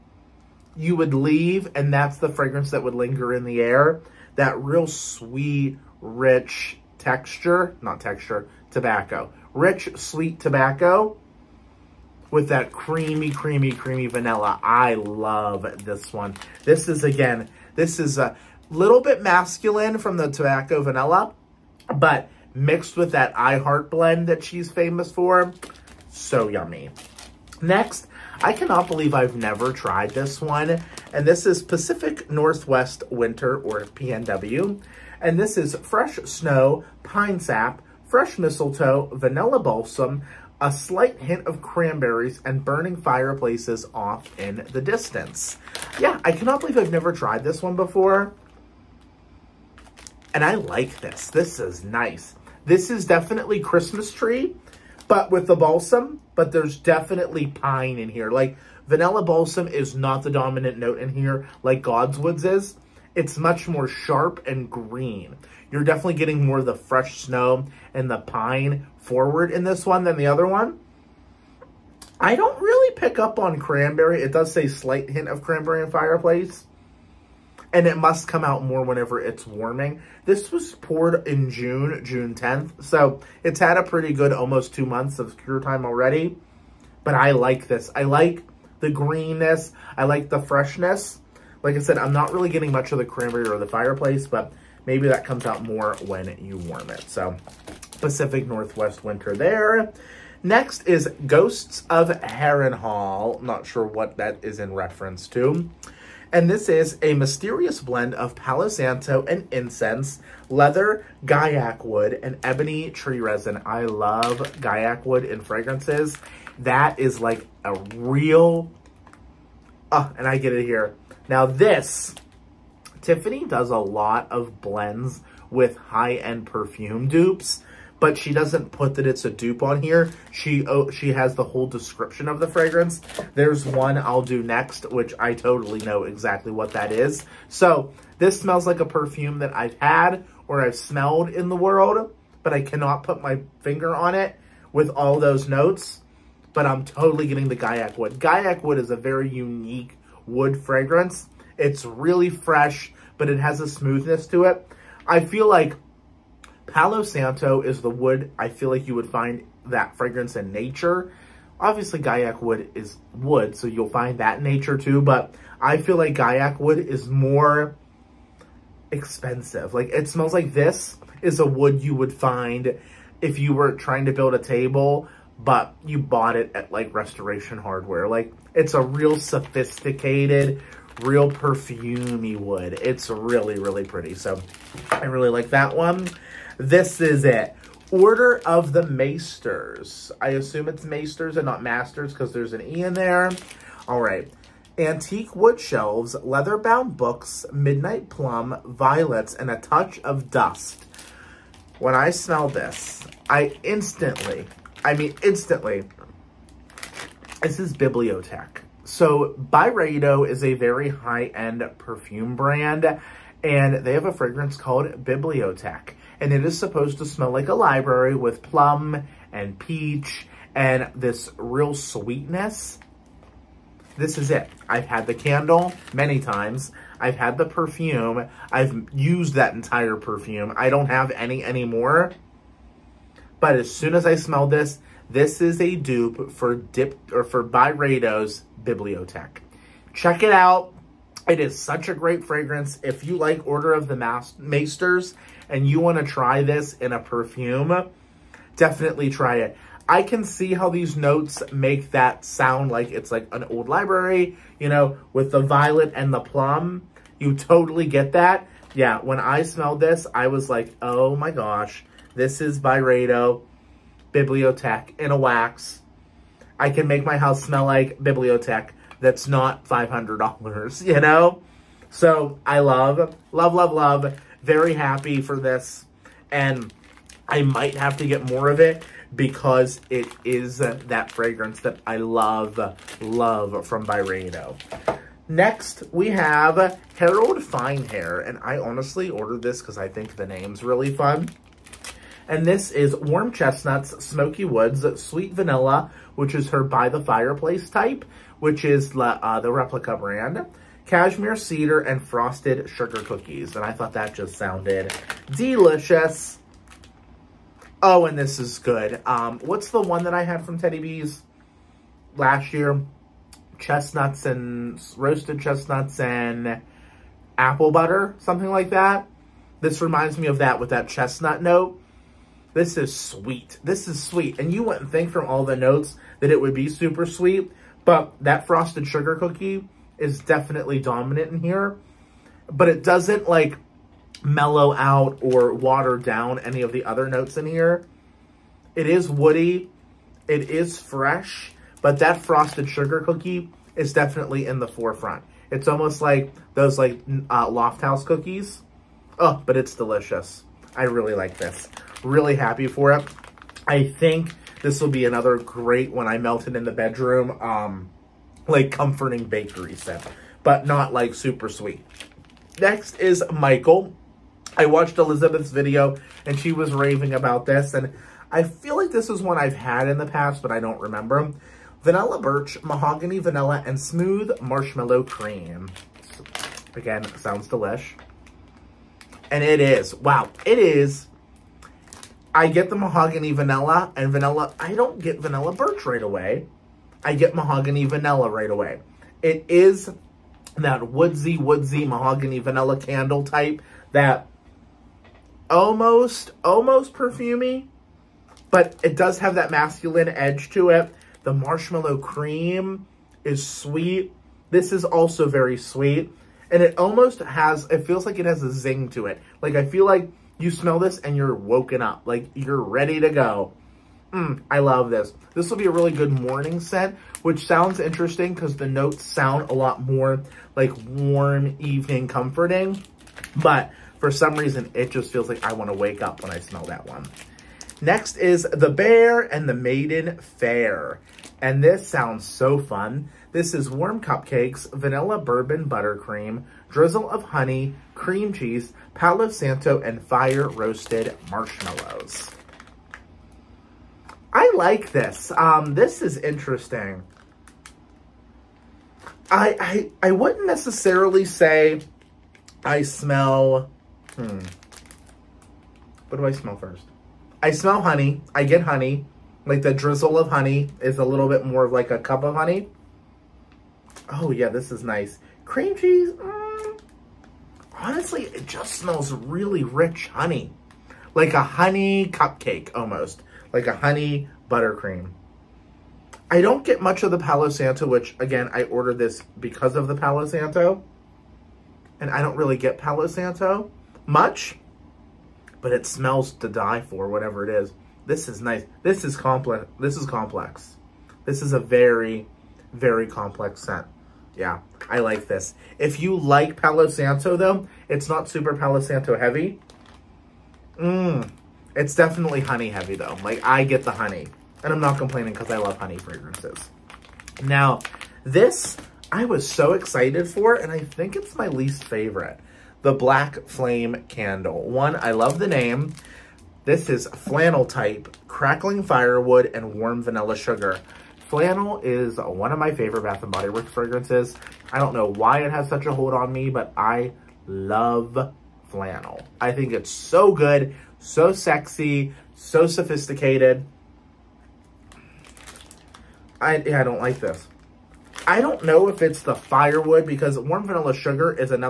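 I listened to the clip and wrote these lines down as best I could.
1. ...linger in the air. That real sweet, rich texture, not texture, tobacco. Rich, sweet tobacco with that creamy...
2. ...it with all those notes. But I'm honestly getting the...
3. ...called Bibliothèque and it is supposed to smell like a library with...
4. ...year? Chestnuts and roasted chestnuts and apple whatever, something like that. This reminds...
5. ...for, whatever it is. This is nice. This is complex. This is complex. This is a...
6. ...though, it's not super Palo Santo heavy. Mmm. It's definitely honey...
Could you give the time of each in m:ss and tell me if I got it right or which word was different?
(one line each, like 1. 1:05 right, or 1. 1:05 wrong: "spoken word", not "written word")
1. 0:02 right
2. 2:24 wrong: "totally", not "honestly"
3. 3:34 right
4. 5:12 wrong: "butter", not "whatever"
5. 8:06 right
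6. 8:17 right.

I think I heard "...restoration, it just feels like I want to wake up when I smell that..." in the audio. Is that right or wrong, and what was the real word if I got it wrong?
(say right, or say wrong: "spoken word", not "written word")
wrong: "reason", not "restoration".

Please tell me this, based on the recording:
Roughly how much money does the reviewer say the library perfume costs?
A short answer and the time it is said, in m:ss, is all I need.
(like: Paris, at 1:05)
$500, at 4:29.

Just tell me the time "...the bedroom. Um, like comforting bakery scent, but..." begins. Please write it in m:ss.
5:56.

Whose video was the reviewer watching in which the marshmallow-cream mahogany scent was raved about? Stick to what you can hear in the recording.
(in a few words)
Elizabeth.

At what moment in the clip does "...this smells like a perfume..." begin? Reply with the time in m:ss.
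2:18.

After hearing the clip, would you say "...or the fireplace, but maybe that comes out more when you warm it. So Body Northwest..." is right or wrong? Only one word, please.
wrong.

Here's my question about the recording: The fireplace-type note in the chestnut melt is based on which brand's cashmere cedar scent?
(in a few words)
Replica.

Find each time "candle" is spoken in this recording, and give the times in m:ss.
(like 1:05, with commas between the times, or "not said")
3:45, 6:32, 8:34.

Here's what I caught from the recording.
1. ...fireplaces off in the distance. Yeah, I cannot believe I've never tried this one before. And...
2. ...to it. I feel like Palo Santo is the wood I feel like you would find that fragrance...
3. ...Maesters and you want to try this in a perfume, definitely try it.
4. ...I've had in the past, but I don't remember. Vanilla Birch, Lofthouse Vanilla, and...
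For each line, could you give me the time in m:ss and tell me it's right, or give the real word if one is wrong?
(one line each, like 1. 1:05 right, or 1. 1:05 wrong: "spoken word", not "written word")
1. 0:42 right
2. 2:34 right
3. 4:04 right
4. 6:09 wrong: "Mahogany", not "Lofthouse".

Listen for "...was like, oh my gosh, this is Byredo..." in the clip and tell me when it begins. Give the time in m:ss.
4:20.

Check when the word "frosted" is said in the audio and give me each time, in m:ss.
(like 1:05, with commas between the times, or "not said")
5:02, 5:28, 5:42.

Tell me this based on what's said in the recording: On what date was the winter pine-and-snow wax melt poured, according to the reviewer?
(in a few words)
June 10th.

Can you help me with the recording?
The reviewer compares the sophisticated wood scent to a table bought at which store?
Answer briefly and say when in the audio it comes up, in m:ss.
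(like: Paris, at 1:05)
Restoration Hardware, at 2:56.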